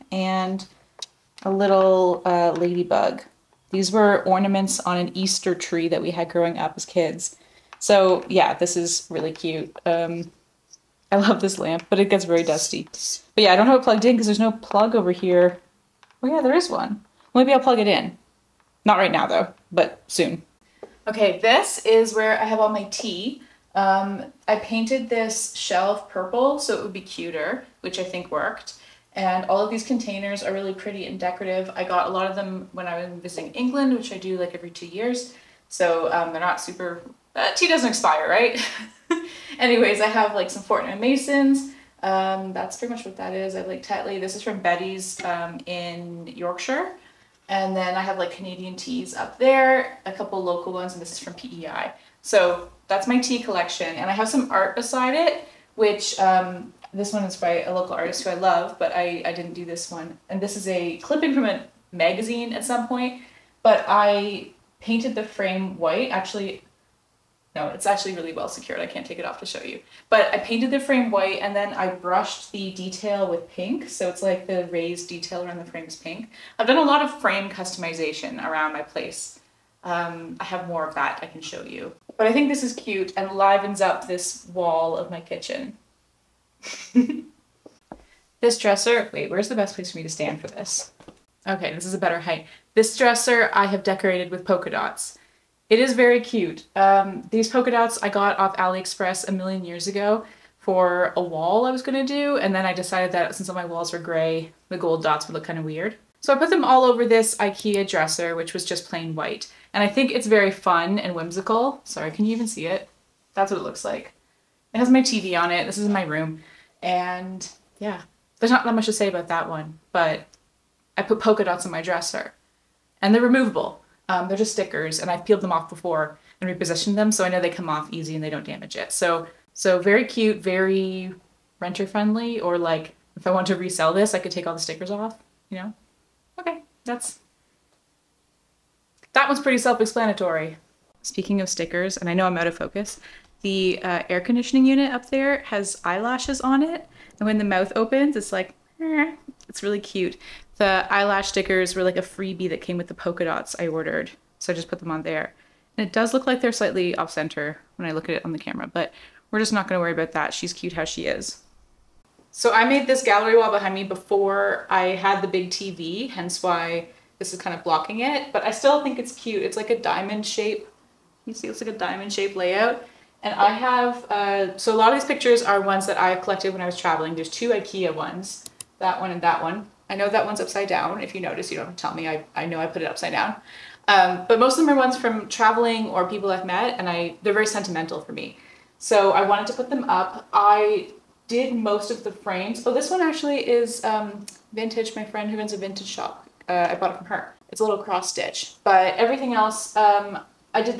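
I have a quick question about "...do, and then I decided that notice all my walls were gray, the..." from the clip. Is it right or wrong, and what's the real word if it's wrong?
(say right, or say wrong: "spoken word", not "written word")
wrong: "since", not "notice".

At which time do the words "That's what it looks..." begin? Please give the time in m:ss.
1:53.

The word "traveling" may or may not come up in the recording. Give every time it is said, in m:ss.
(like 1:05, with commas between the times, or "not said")
2:56, 3:05.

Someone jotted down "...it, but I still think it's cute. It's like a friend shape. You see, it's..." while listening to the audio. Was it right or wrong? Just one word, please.
wrong.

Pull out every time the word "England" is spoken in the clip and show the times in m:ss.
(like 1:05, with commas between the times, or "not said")
0:33.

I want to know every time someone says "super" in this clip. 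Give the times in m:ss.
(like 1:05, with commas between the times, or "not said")
0:36.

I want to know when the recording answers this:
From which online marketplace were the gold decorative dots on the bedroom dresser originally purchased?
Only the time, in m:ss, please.
1:38.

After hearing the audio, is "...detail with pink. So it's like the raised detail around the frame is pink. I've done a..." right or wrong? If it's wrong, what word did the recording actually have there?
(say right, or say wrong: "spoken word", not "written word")
right.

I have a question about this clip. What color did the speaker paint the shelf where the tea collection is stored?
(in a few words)
purple.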